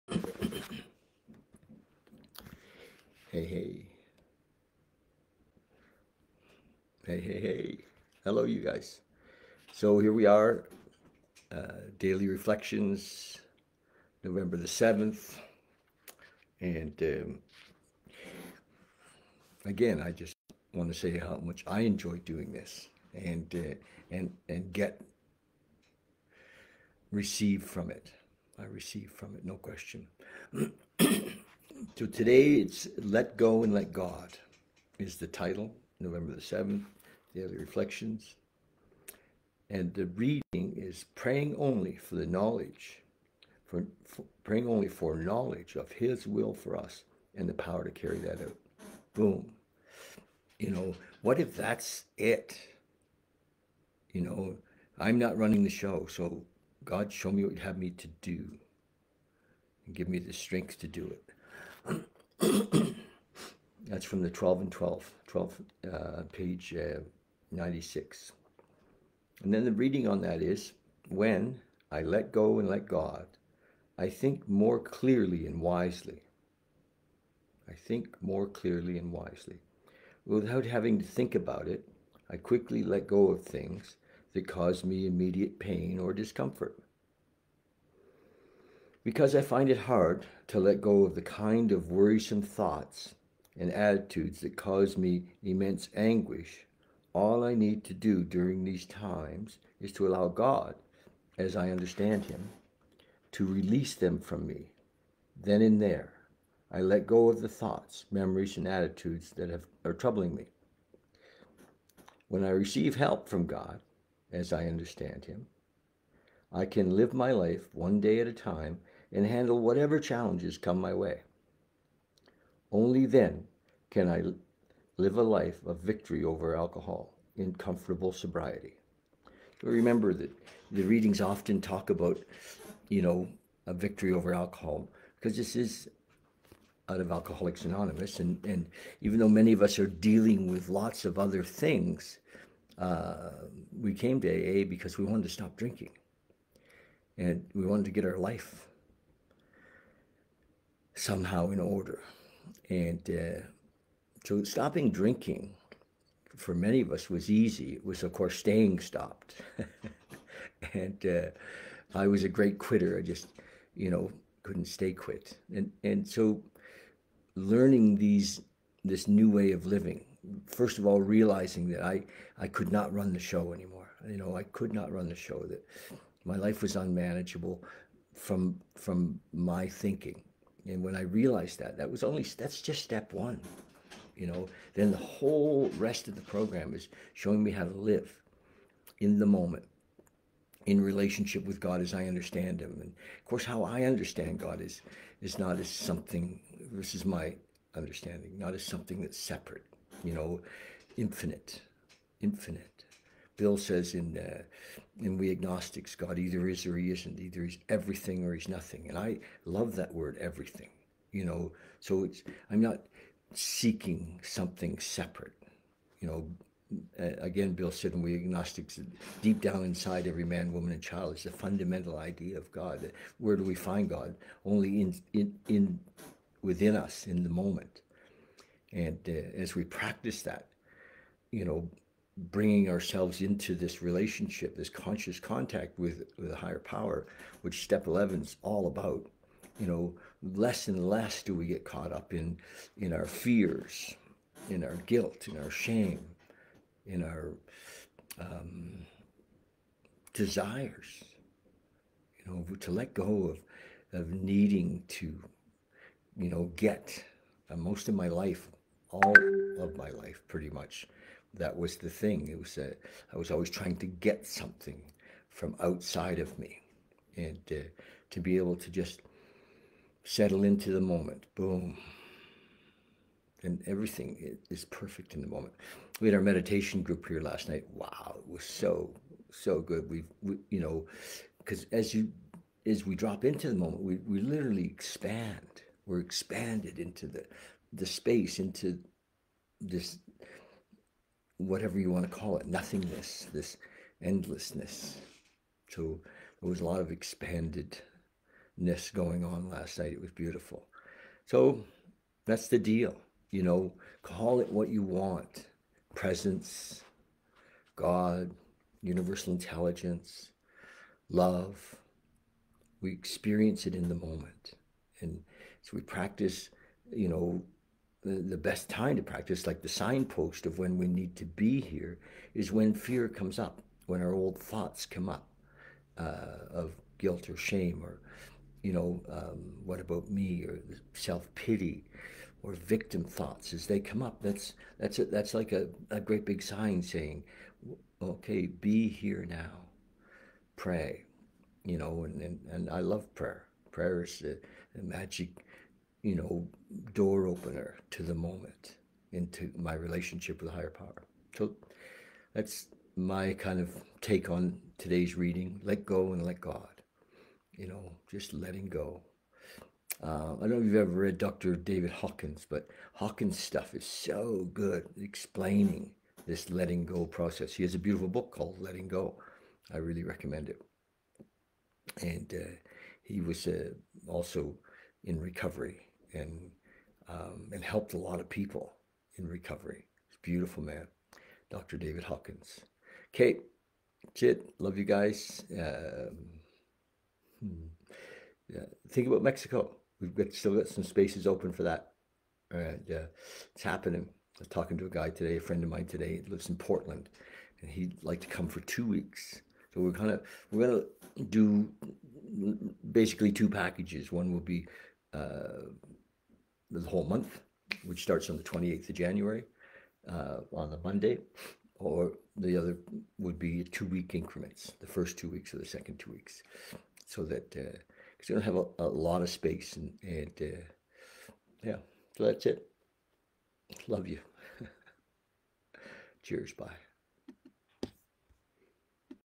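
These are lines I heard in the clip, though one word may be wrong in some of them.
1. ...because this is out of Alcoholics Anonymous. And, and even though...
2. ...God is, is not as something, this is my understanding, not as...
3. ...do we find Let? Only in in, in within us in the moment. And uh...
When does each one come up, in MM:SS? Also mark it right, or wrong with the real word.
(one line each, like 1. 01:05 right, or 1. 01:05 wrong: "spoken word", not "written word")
1. 02:15 right
2. 03:14 right
3. 03:43 wrong: "God", not "Let".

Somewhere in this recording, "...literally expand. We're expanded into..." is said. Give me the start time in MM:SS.
04:44.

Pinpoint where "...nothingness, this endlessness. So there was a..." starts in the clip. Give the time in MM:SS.
04:52.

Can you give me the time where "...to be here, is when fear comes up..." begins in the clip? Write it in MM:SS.
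05:21.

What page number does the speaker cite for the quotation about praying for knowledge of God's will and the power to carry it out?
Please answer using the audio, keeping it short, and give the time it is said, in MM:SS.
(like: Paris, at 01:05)
96, at 01:07.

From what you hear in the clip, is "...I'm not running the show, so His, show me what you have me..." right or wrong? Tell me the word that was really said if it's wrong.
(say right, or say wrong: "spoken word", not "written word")
wrong: "God", not "His".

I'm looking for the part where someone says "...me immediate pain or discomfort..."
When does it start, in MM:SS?
01:24.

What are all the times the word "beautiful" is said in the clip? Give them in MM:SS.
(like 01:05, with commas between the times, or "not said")
05:00, 06:07, 06:20.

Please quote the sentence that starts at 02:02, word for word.
Only then can I live a life of victory over alcohol in comfortable sobriety.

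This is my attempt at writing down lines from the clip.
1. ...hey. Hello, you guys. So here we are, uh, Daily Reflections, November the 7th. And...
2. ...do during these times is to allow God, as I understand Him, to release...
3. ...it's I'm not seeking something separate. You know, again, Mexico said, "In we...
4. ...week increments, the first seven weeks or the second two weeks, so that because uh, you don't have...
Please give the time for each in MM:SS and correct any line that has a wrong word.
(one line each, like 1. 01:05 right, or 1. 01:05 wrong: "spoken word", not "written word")
1. 00:07 right
2. 01:37 right
3. 03:32 wrong: "Bill", not "Mexico"
4. 06:53 wrong: "two", not "seven".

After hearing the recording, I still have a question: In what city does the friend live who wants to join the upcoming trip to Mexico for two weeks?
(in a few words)
Portland.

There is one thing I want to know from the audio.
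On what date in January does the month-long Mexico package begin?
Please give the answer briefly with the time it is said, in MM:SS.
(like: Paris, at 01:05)
January 28, at 06:48.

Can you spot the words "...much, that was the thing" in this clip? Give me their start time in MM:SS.
04:20.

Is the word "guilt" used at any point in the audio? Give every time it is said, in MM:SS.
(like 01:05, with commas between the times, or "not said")
04:04, 05:26.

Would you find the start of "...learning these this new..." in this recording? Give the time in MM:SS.
02:47.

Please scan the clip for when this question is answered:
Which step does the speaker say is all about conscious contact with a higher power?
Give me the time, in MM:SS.
03:57.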